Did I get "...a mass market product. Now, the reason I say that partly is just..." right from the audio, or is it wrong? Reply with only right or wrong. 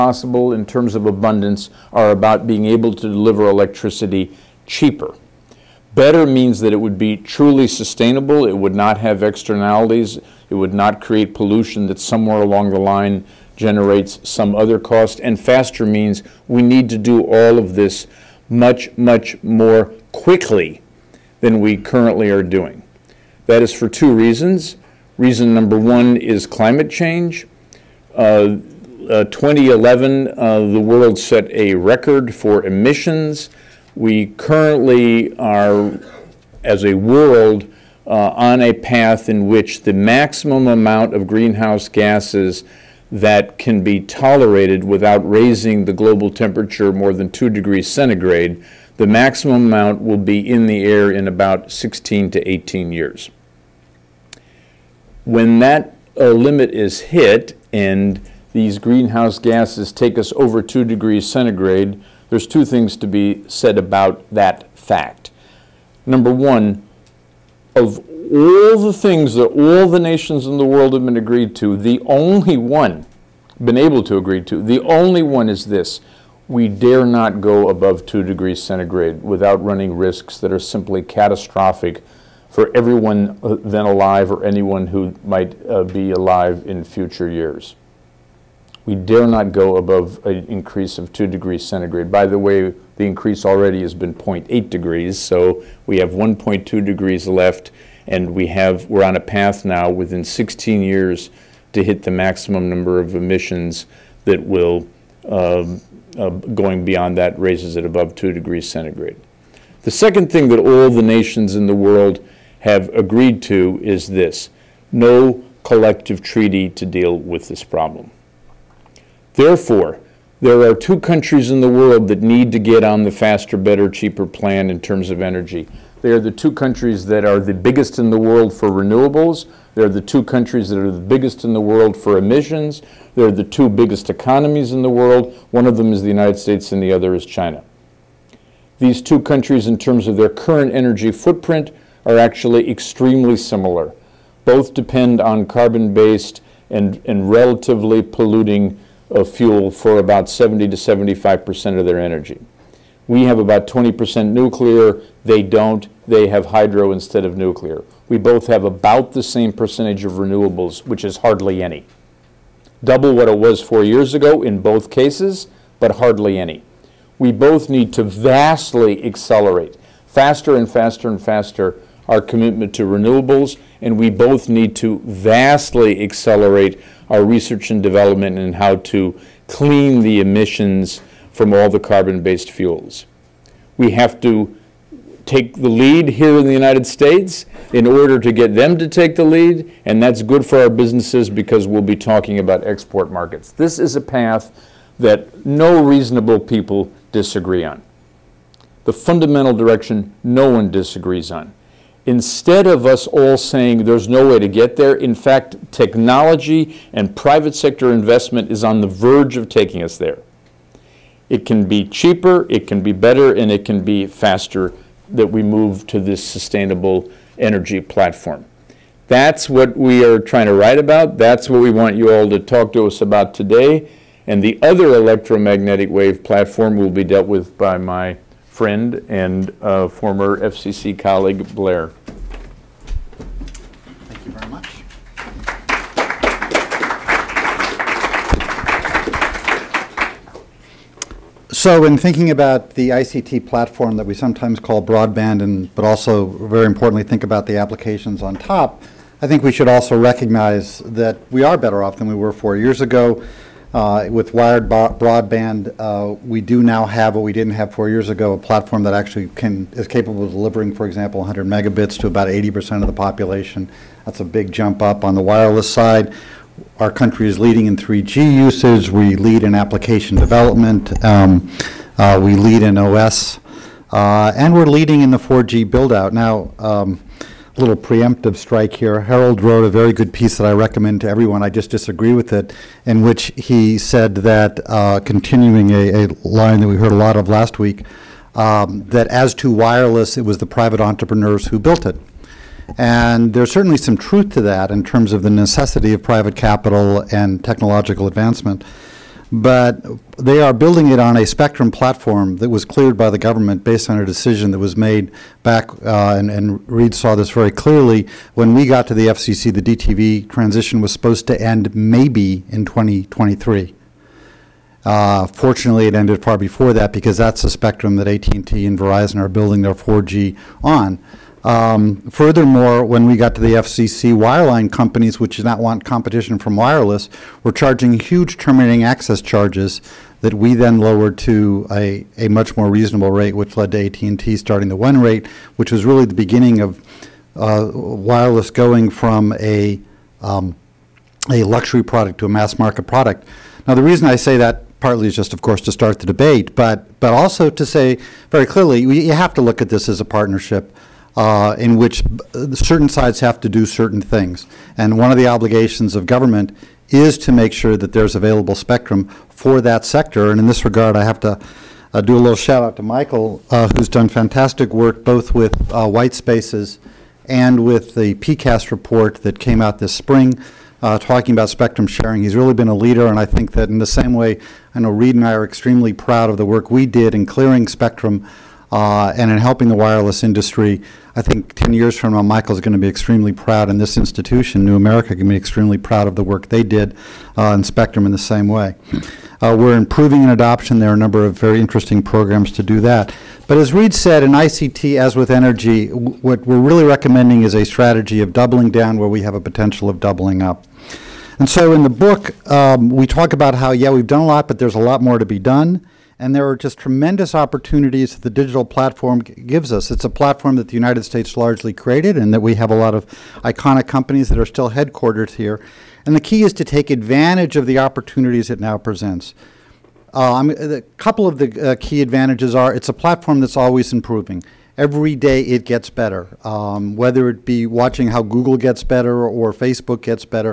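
right.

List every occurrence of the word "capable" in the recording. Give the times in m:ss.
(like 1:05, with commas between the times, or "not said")
4:19.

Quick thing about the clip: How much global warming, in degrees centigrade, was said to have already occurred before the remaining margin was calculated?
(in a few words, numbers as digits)
0.8 degrees.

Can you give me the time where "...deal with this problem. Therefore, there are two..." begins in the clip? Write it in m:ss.
1:56.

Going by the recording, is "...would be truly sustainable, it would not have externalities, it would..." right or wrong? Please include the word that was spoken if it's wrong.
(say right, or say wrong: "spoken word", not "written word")
right.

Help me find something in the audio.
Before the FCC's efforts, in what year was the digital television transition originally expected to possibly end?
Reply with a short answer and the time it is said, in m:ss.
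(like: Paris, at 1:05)
2023, at 5:12.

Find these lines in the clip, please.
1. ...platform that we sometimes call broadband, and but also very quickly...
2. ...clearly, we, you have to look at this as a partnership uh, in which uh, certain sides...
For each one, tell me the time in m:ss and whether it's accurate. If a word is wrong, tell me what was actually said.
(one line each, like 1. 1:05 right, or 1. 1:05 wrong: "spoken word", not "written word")
1. 4:03 wrong: "importantly", not "quickly"
2. 5:48 right.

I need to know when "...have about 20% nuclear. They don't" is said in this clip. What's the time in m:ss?
2:33.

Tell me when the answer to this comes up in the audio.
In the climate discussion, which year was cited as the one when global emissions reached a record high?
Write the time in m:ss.
0:29.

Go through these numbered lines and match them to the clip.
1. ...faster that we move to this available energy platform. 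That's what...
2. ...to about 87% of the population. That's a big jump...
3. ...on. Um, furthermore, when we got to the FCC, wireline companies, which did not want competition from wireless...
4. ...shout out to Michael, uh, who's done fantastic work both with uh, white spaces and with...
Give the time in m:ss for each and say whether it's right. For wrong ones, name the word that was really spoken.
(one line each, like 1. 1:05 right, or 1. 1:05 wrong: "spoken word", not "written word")
1. 3:34 wrong: "sustainable", not "available"
2. 4:21 wrong: "80", not "87"
3. 5:20 right
4. 6:02 right.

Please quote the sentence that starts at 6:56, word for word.
And the key is to take advantage of the opportunities it now presents.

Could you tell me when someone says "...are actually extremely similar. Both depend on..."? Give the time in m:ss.
2:22.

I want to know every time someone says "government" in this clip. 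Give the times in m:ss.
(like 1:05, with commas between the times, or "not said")
5:03, 5:56.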